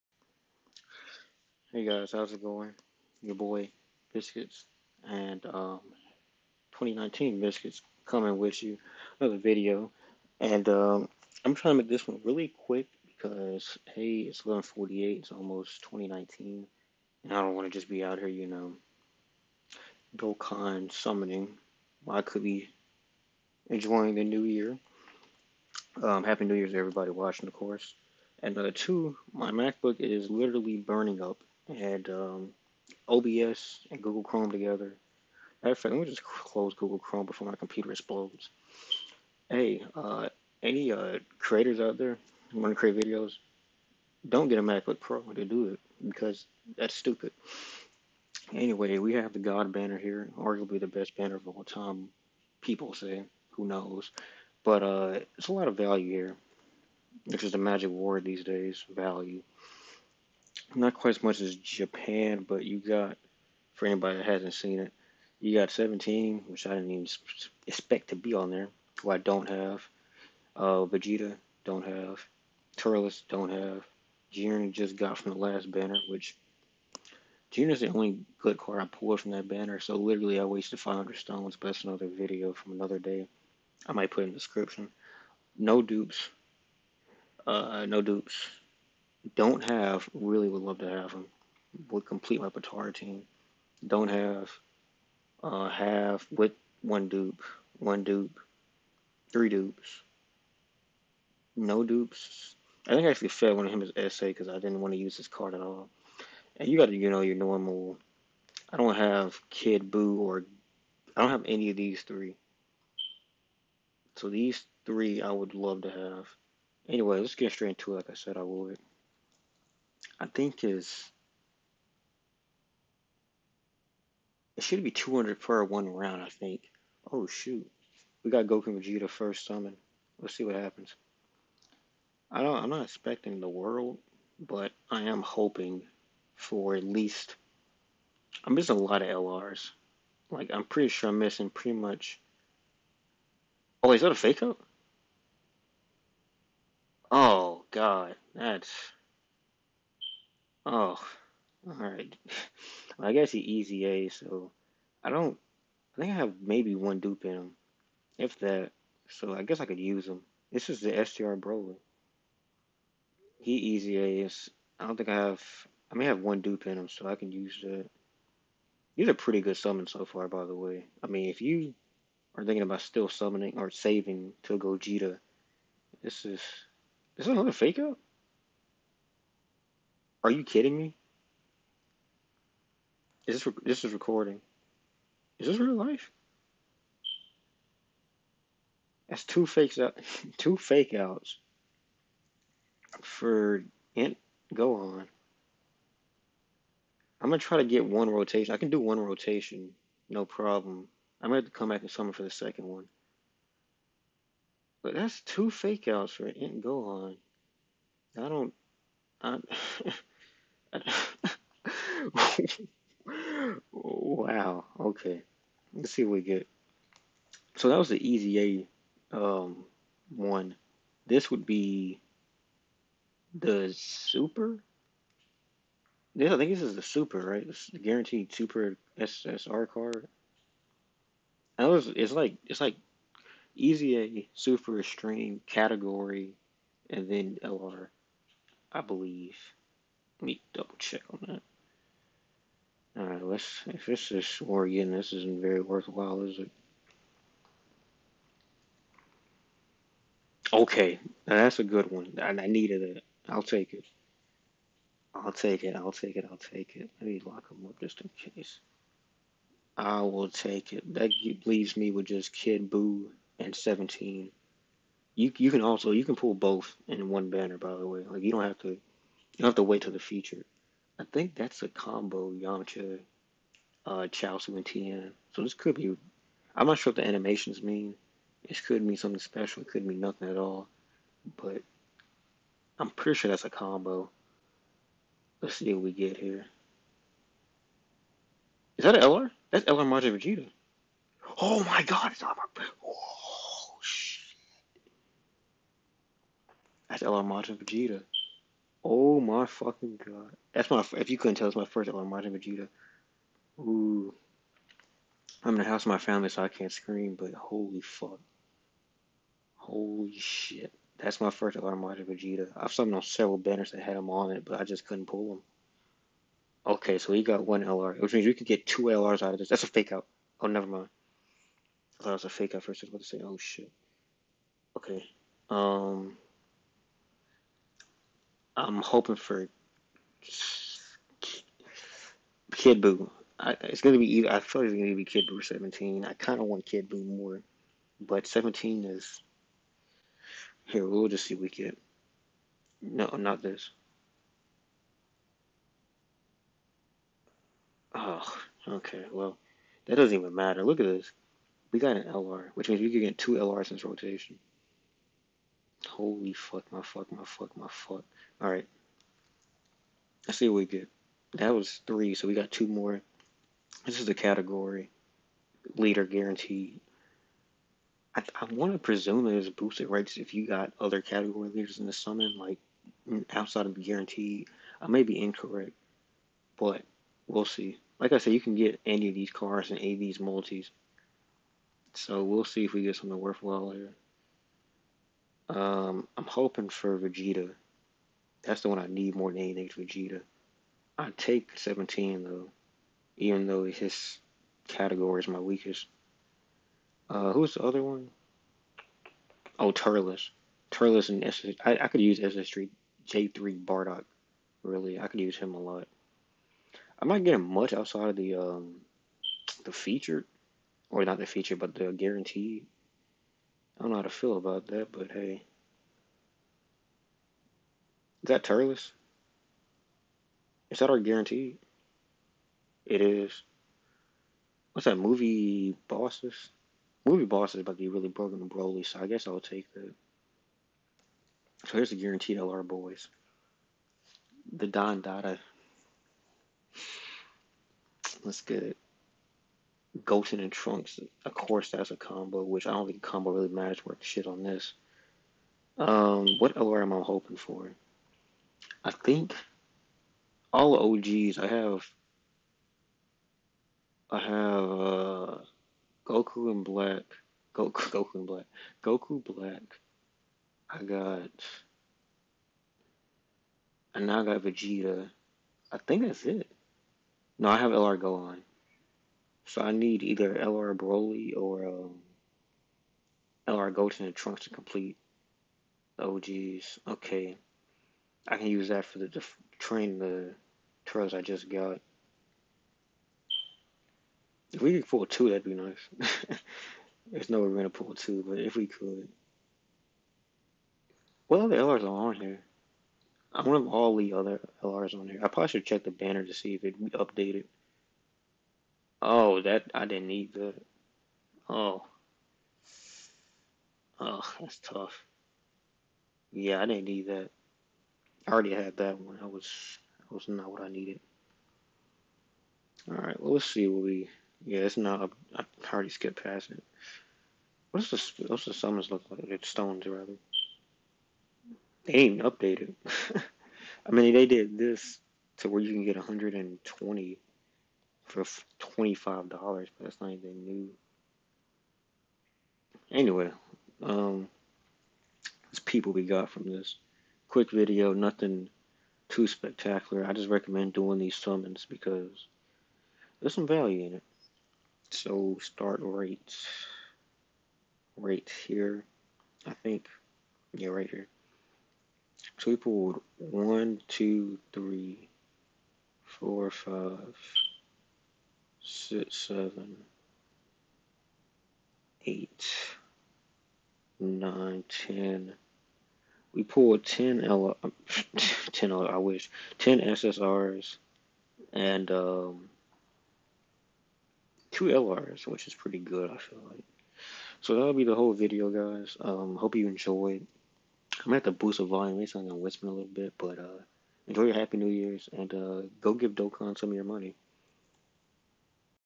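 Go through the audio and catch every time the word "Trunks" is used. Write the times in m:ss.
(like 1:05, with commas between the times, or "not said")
7:20, 7:54.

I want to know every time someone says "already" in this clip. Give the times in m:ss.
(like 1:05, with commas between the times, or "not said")
8:28, 8:35.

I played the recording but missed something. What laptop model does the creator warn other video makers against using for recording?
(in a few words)
MacBook Pro.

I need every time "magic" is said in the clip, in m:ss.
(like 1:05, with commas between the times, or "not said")
0:57.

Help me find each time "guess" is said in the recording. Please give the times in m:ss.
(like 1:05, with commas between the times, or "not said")
2:33, 2:39, 7:09.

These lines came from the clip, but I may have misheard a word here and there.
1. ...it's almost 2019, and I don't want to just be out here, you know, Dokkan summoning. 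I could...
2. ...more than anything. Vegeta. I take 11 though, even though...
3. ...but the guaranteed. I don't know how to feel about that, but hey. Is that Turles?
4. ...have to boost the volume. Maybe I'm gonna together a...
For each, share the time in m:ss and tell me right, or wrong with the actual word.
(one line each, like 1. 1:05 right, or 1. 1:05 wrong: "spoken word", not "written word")
1. 0:15 right
2. 6:29 wrong: "17", not "11"
3. 6:51 right
4. 9:41 wrong: "whisper", not "together".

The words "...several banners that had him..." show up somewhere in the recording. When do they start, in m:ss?
5:13.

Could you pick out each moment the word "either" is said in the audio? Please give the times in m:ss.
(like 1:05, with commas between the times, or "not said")
5:34, 7:50.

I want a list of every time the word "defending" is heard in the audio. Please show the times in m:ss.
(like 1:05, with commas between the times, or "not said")
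not said.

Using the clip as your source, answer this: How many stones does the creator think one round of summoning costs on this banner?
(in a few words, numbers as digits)
200.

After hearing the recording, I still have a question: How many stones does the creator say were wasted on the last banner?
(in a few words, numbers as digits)
500.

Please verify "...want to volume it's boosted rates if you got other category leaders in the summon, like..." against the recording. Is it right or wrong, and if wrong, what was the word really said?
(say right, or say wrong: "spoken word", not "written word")
wrong: "presume", not "volume".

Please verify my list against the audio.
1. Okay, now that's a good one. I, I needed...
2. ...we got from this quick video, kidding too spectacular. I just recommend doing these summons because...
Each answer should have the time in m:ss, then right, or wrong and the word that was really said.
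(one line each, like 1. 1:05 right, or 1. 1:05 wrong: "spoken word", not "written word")
1. 4:10 right
2. 8:55 wrong: "nothing", not "kidding".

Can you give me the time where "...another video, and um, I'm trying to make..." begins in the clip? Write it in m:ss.
0:09.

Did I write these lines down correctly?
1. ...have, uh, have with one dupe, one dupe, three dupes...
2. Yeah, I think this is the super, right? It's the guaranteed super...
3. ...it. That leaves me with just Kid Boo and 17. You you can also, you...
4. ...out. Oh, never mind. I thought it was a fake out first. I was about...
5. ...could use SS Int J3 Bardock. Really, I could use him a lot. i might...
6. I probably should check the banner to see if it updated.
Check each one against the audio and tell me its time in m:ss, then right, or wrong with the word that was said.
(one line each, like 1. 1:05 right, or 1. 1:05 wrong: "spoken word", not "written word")
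1. 1:34 right
2. 3:46 right
3. 4:20 right
4. 5:19 right
5. 6:41 wrong: "Street", not "Int"
6. 8:15 right.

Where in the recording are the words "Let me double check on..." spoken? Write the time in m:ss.
4:00.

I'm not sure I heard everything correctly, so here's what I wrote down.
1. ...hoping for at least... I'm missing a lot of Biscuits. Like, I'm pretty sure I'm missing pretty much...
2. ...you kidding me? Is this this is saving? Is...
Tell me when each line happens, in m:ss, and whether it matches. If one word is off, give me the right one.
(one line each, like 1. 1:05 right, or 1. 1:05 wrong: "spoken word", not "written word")
1. 2:15 wrong: "LRs", not "Biscuits"
2. 3:00 wrong: "recording", not "saving".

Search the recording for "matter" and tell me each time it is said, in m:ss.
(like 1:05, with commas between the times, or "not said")
0:35, 5:50, 7:23.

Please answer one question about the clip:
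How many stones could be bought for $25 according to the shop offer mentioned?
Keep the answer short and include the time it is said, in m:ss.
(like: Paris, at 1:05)
120, at 8:45.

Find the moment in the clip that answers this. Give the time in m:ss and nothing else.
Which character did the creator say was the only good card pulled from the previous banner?
1:14.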